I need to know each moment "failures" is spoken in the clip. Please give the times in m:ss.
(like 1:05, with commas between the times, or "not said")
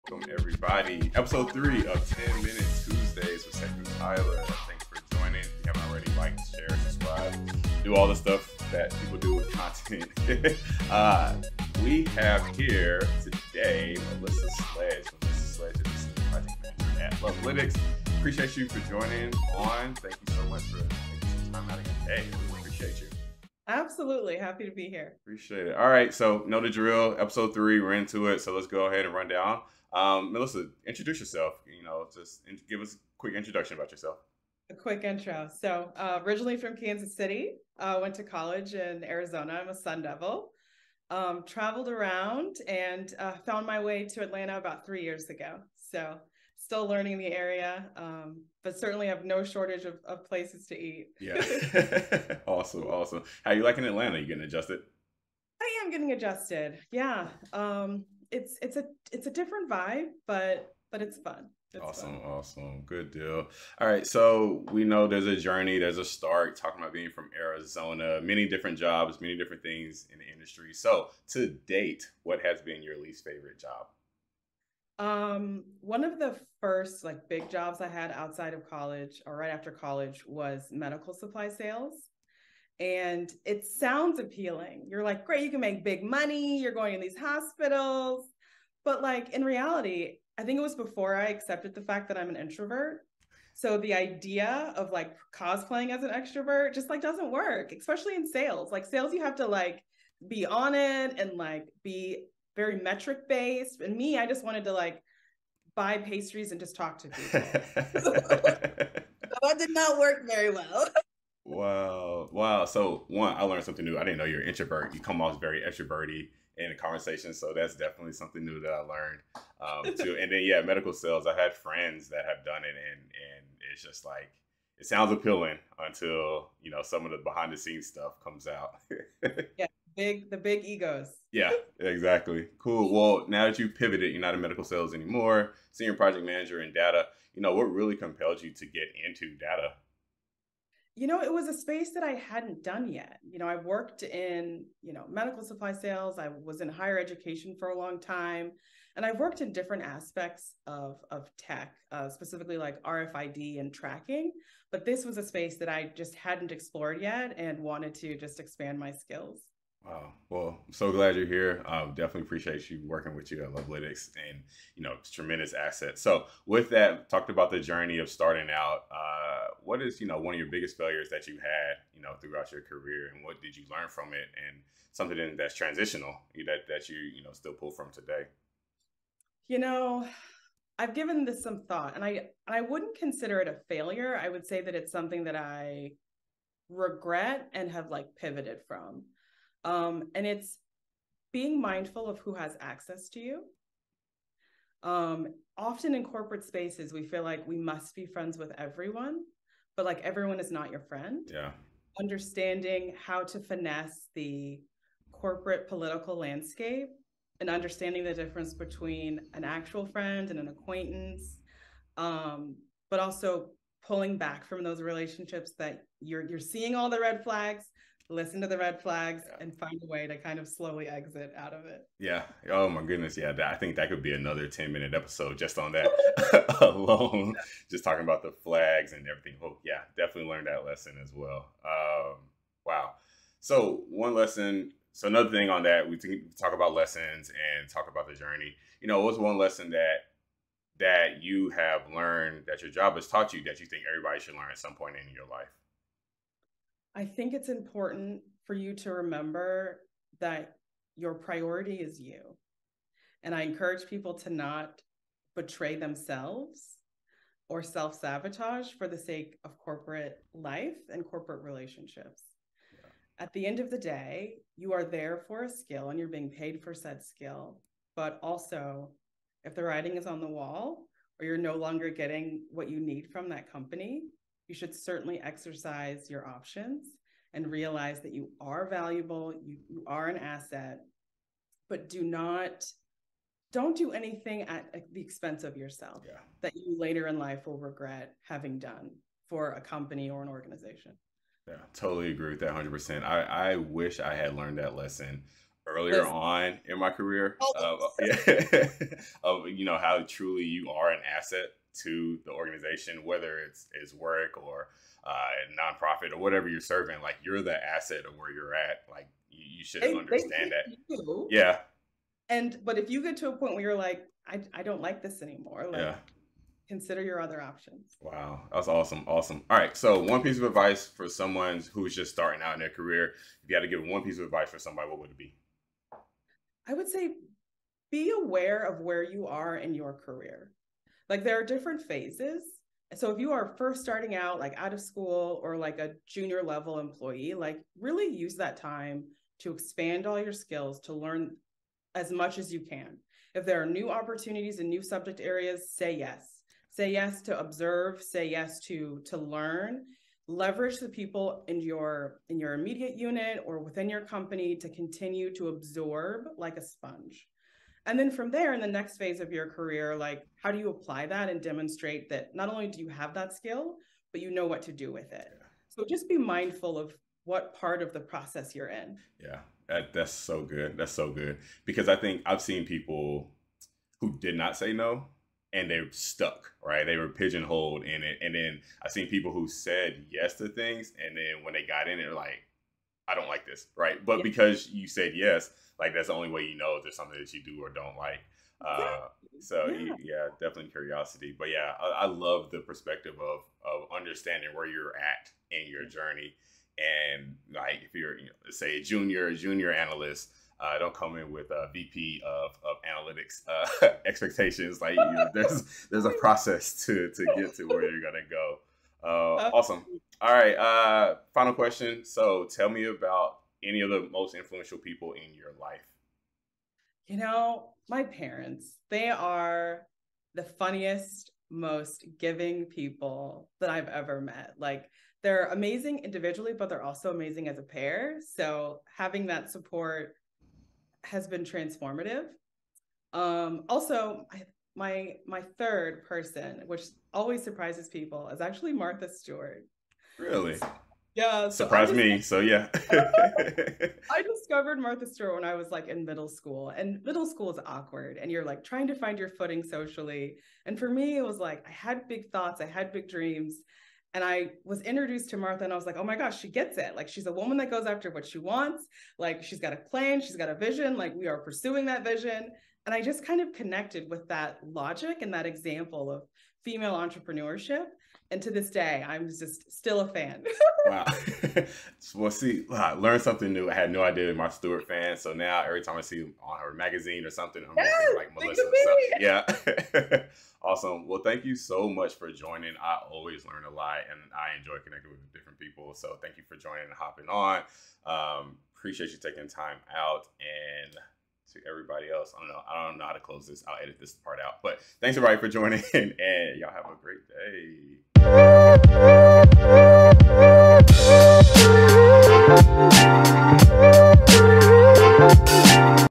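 2:50, 3:03.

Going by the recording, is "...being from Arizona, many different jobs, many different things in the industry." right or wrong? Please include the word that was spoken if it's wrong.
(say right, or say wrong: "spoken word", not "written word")
right.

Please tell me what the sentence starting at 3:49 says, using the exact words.
Oh yeah, definitely learned that lesson as well.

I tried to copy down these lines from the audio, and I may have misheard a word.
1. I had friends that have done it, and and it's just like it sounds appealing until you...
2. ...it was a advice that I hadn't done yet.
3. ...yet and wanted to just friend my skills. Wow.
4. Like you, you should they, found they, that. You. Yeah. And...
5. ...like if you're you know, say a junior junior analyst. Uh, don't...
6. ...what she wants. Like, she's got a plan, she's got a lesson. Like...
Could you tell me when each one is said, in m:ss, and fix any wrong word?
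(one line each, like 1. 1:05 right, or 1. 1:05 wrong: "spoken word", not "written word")
1. 2:01 right
2. 2:21 wrong: "space", not "advice"
3. 2:37 wrong: "expand", not "friend"
4. 5:08 wrong: "understand", not "found"
5. 6:37 right
6. 7:38 wrong: "vision", not "lesson".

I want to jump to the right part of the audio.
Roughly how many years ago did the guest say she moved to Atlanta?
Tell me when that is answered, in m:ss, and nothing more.
0:44.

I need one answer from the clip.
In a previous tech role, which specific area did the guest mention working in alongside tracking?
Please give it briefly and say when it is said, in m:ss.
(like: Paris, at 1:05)
RFID, at 2:32.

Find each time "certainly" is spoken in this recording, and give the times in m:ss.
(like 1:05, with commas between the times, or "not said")
0:48, 4:34.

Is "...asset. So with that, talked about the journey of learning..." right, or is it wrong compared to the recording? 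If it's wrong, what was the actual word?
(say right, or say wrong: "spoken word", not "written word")
wrong: "starting", not "learning".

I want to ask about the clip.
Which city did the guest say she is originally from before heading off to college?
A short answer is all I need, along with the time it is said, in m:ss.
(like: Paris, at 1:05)
Kansas City, at 0:36.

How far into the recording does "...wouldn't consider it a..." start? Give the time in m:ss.
3:02.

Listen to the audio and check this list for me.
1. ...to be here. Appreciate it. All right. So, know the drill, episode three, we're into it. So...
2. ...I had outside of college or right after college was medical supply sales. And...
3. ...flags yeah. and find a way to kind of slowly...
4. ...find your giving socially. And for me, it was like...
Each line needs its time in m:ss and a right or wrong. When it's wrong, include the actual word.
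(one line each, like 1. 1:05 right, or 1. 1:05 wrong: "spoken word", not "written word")
1. 0:24 right
2. 1:17 right
3. 3:38 right
4. 7:28 wrong: "footing", not "giving".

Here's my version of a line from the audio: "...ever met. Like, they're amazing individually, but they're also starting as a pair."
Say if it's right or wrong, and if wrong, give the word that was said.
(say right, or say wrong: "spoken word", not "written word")
wrong: "amazing", not "starting".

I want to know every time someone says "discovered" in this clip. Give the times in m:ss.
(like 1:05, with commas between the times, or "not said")
7:24.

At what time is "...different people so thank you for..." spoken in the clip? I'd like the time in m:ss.
8:05.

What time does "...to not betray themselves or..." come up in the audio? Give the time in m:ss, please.
4:14.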